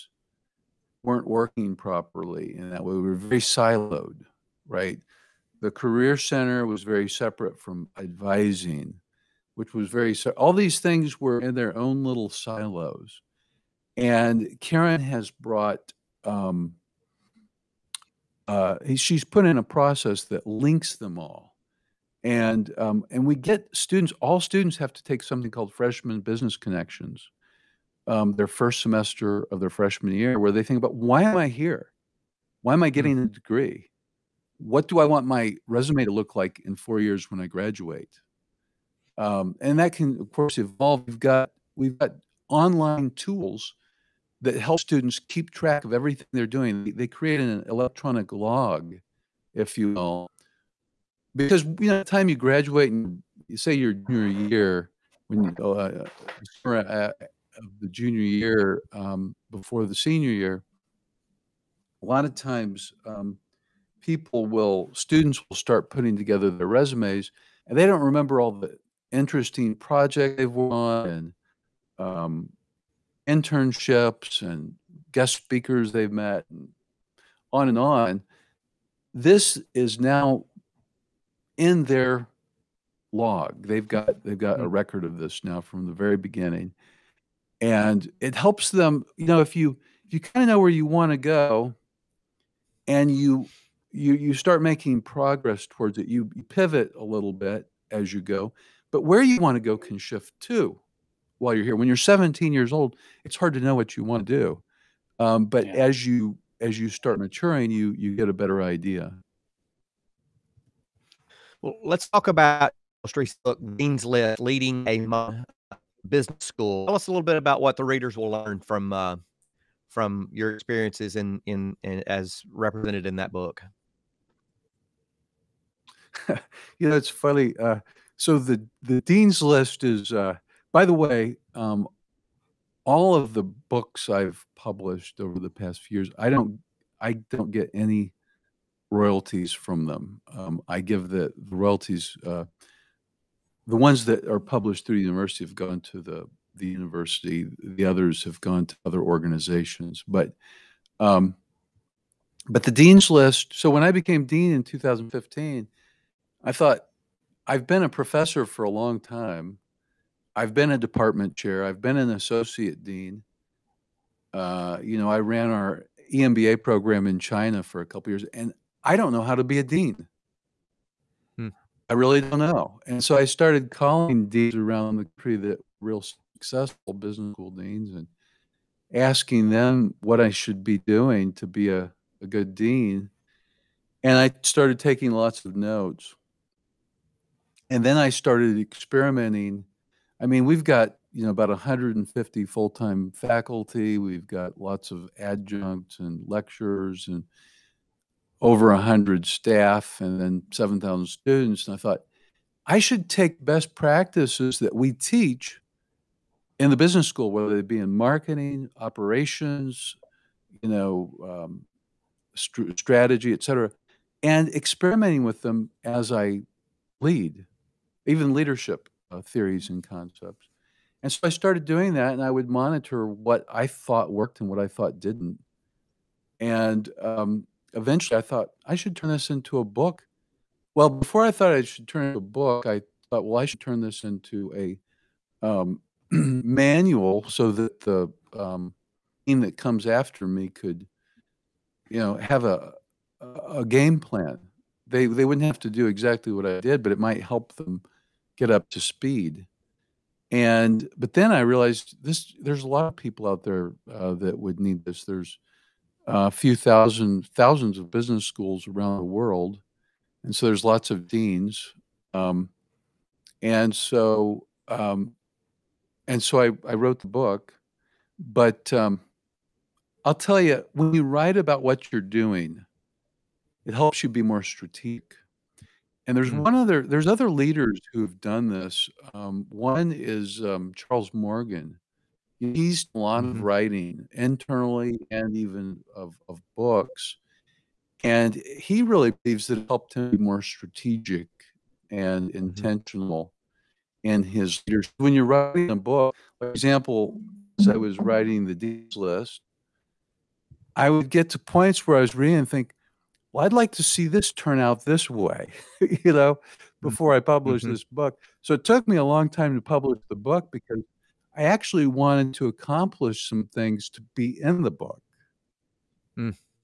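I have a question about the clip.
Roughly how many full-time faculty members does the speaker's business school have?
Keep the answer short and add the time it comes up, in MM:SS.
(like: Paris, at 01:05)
150, at 03:11.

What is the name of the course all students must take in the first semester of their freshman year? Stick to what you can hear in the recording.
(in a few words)
Freshman Business Connections.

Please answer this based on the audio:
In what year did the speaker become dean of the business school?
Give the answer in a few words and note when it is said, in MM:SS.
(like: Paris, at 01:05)
2015, at 02:34.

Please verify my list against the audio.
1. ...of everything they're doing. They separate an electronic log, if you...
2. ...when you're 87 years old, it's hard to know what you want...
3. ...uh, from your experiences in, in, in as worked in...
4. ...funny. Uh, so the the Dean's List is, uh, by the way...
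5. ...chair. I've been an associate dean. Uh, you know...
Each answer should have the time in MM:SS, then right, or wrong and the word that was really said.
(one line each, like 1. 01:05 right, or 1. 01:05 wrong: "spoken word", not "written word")
1. 00:45 wrong: "create", not "separate"
2. 01:41 wrong: "17", not "87"
3. 01:58 wrong: "represented", not "worked"
4. 02:07 right
5. 02:41 right.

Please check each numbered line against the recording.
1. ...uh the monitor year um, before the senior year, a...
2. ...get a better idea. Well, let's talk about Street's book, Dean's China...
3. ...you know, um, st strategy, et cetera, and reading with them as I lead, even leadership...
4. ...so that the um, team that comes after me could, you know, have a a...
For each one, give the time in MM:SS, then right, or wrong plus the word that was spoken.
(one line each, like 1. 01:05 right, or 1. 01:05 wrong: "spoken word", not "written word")
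1. 00:56 wrong: "junior", not "monitor"
2. 01:48 wrong: "List", not "China"
3. 03:30 wrong: "experimenting", not "reading"
4. 03:57 right.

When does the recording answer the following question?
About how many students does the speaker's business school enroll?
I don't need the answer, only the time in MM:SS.
03:20.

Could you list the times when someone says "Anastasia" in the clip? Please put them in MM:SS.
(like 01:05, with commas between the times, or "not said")
not said.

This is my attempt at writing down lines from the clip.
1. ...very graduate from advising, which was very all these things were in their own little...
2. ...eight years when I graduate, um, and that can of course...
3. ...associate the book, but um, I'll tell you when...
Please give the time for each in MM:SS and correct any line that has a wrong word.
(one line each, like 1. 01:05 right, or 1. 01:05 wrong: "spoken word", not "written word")
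1. 00:06 wrong: "separate", not "graduate"
2. 00:36 wrong: "four", not "eight"
3. 04:26 wrong: "wrote", not "associate".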